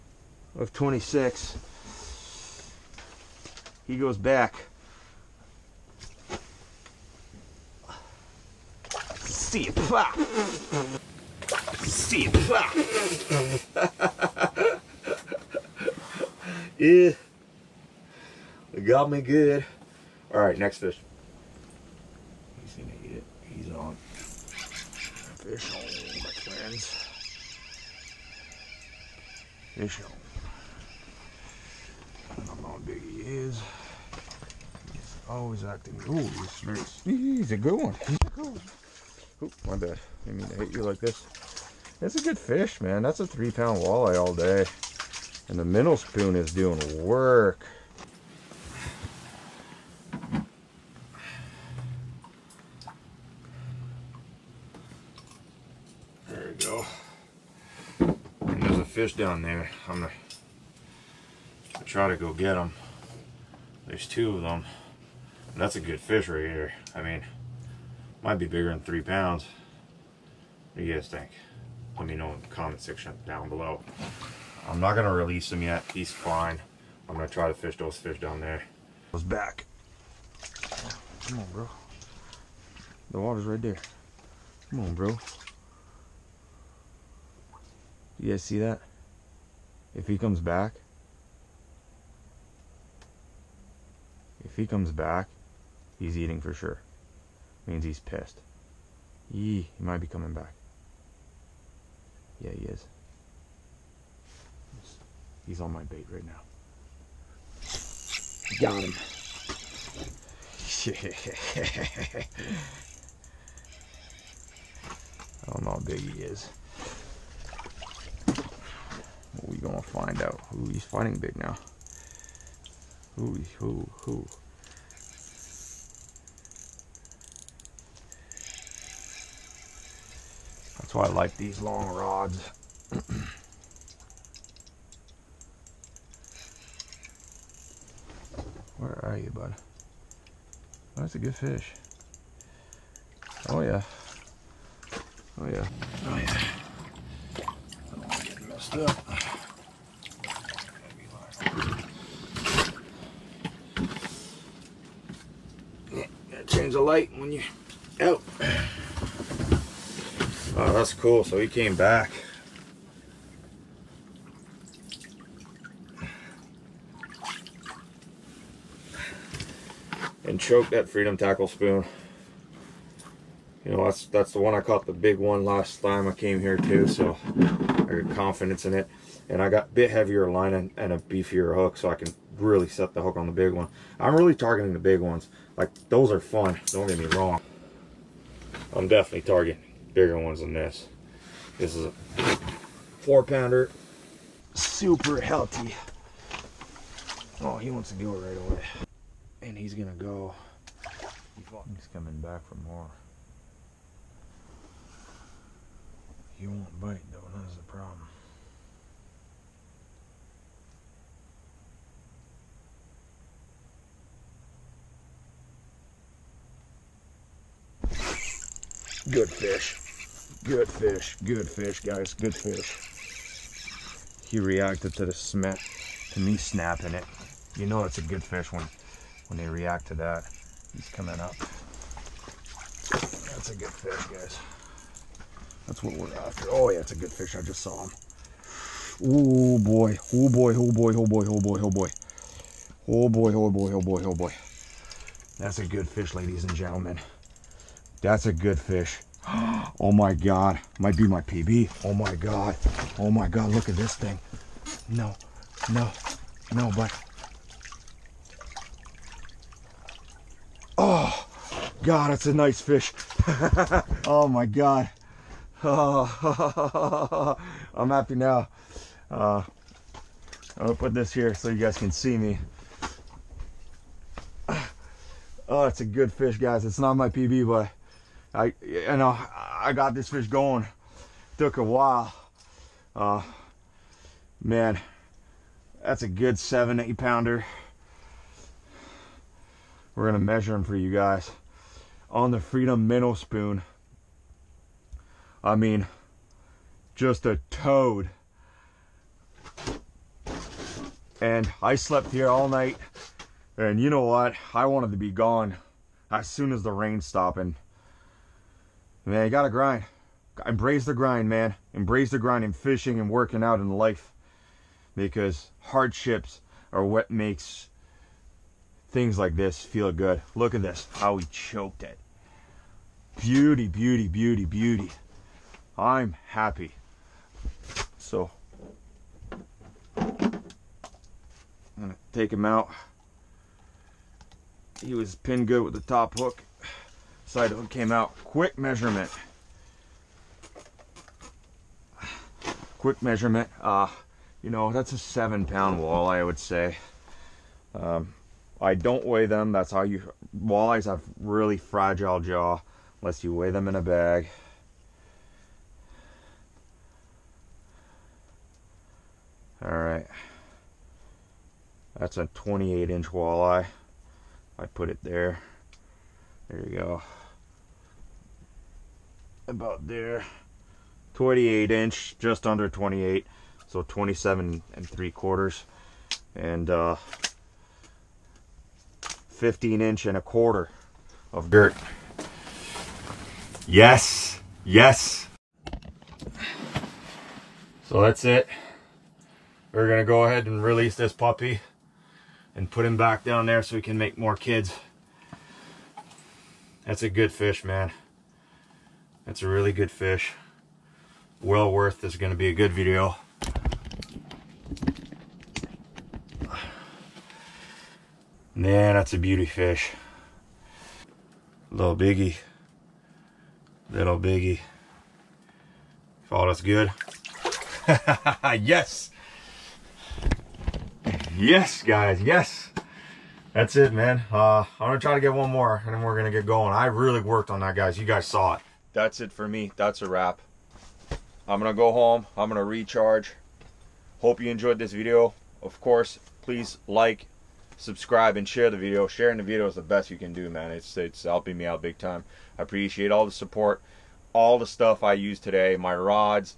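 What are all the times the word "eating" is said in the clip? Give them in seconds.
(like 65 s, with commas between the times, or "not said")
96 s.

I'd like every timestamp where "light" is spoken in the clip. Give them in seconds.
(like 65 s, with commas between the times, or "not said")
156 s.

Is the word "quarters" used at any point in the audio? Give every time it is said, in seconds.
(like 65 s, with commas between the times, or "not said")
375 s, 380 s.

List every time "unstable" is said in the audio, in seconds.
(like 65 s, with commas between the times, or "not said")
not said.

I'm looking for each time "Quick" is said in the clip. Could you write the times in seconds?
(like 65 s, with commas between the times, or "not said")
338 s, 342 s.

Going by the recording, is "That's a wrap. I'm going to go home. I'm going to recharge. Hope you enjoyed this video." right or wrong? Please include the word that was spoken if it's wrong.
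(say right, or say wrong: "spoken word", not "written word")
right.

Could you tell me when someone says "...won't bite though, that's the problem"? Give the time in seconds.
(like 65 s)
206 s.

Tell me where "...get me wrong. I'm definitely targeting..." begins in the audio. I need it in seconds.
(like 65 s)
186 s.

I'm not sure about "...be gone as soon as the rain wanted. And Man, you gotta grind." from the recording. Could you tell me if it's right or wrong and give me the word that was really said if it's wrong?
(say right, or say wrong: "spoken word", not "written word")
wrong: "stopped", not "wanted".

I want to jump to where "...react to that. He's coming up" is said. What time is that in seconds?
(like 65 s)
229 s.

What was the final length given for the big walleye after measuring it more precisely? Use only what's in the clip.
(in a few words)
27 and 3/4 inches.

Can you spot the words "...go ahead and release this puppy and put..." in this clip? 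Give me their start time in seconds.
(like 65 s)
390 s.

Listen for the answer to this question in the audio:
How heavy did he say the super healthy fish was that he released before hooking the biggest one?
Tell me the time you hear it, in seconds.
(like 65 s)
193 s.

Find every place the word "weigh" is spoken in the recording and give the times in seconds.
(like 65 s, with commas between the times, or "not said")
349 s, 353 s.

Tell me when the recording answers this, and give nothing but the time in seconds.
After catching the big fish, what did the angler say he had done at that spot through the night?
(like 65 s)
301 s.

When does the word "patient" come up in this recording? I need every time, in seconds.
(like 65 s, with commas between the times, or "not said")
not said.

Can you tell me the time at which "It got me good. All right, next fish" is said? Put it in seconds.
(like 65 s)
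18 s.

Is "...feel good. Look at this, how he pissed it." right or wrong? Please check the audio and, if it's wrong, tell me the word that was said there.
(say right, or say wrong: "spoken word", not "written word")
wrong: "choked", not "pissed".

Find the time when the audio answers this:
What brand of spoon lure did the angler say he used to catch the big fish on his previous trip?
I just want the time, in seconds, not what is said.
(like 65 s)
170 s.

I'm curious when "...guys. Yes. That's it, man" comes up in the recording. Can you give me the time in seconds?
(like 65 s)
421 s.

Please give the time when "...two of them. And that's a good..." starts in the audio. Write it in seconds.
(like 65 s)
64 s.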